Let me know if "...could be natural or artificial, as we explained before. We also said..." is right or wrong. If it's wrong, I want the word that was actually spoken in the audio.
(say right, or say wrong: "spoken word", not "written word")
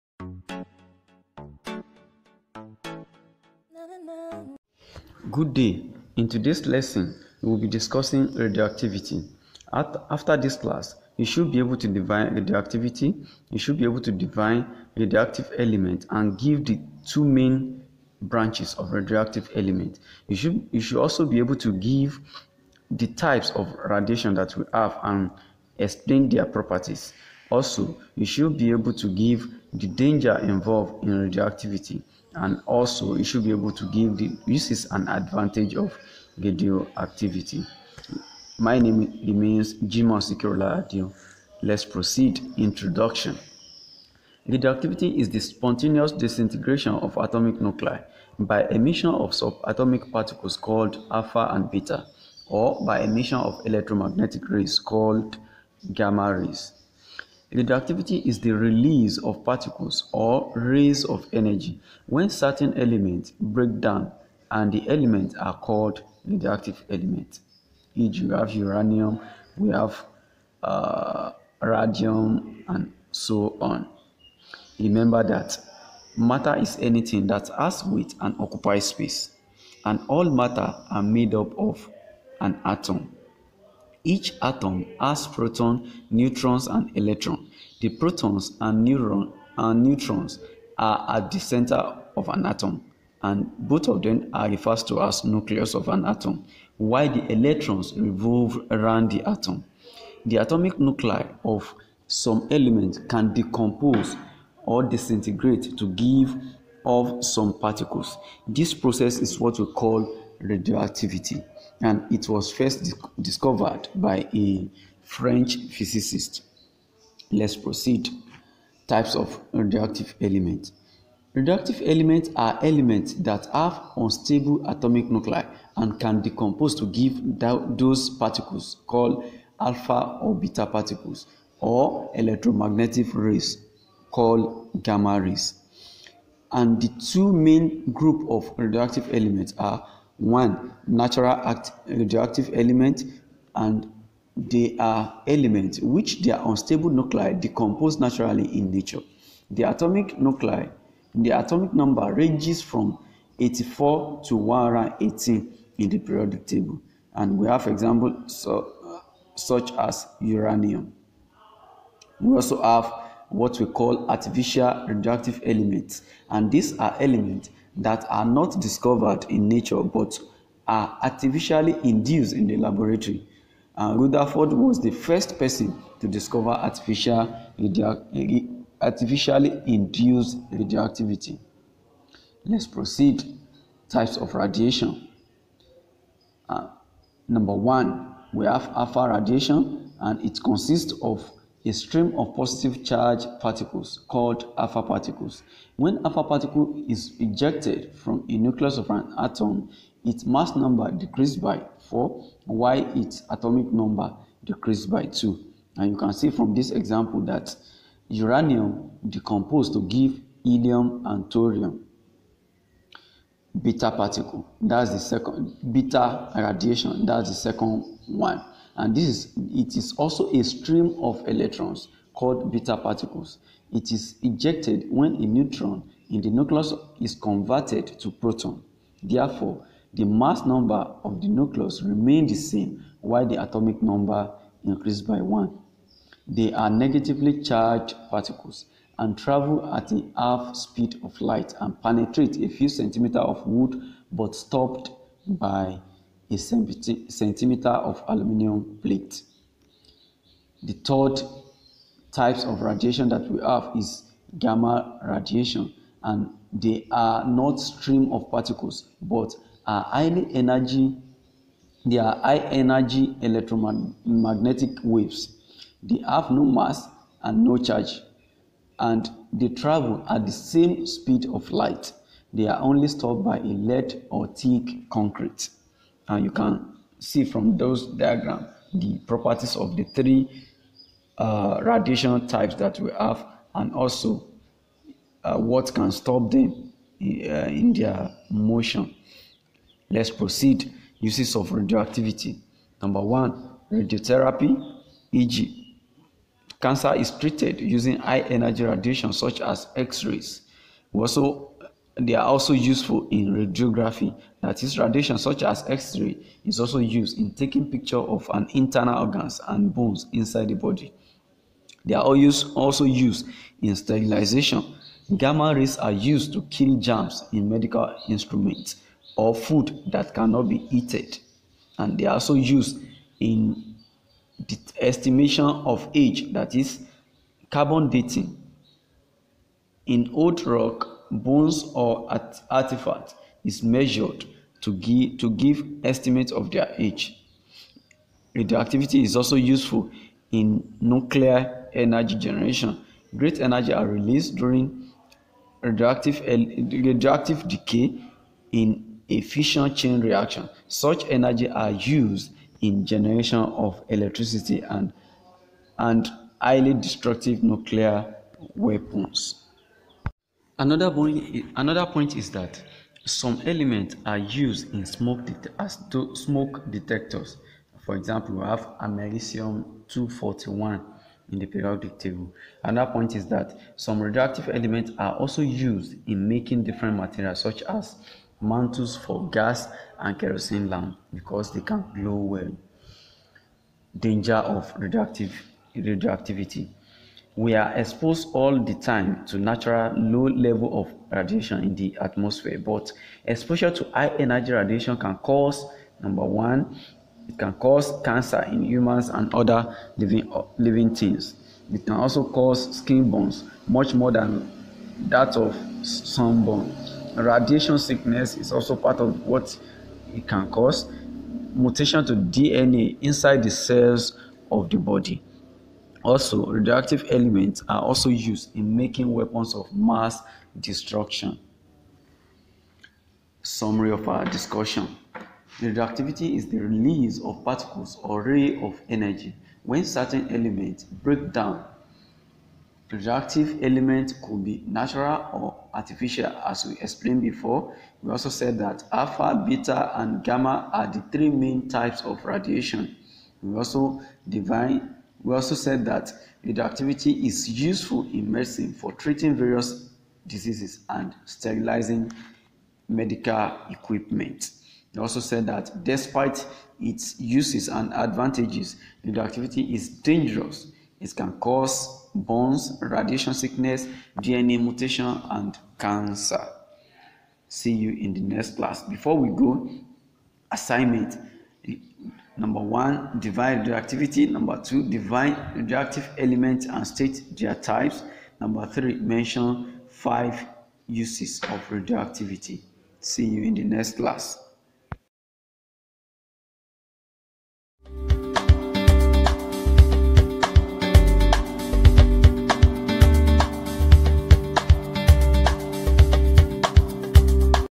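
right.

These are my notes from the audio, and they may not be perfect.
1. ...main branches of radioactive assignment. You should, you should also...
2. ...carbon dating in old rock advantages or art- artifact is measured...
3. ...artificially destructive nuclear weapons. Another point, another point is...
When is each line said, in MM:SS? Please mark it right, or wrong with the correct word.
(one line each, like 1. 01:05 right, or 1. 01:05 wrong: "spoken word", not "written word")
1. 00:17 wrong: "element", not "assignment"
2. 05:27 wrong: "bones", not "advantages"
3. 05:56 wrong: "highly", not "artificially".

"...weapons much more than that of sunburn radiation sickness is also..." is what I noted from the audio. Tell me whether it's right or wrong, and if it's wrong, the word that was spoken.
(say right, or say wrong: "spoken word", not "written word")
wrong: "burns", not "weapons".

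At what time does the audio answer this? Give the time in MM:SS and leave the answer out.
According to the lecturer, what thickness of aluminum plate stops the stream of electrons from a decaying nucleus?
04:06.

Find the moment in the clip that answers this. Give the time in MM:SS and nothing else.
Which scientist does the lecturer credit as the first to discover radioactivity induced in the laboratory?
02:54.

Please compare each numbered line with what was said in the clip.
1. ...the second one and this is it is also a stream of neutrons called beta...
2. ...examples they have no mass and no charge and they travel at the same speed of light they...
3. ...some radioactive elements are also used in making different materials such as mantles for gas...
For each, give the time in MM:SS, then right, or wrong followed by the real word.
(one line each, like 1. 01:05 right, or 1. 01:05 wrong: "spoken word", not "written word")
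1. 03:37 wrong: "electrons", not "neutrons"
2. 04:24 wrong: "waves", not "examples"
3. 06:13 right.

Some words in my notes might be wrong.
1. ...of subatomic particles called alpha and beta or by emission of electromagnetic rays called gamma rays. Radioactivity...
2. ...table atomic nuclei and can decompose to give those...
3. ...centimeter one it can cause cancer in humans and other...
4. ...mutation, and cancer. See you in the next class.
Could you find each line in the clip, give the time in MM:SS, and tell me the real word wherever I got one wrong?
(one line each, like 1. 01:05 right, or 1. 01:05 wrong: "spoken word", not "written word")
1. 00:49 right
2. 02:03 wrong: "unstable", not "table"
3. 06:36 wrong: "number", not "centimeter"
4. 07:44 right.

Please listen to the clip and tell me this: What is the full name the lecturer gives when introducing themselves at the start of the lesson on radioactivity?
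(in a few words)
Jimon Sikiola Adio.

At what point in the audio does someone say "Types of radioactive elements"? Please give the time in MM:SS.
01:58.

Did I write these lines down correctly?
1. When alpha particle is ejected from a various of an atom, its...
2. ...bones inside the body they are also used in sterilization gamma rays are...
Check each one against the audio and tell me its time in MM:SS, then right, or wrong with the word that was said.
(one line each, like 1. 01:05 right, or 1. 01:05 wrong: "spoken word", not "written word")
1. 03:15 wrong: "nucleus", not "various"
2. 05:09 right.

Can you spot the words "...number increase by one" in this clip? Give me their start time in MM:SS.
03:53.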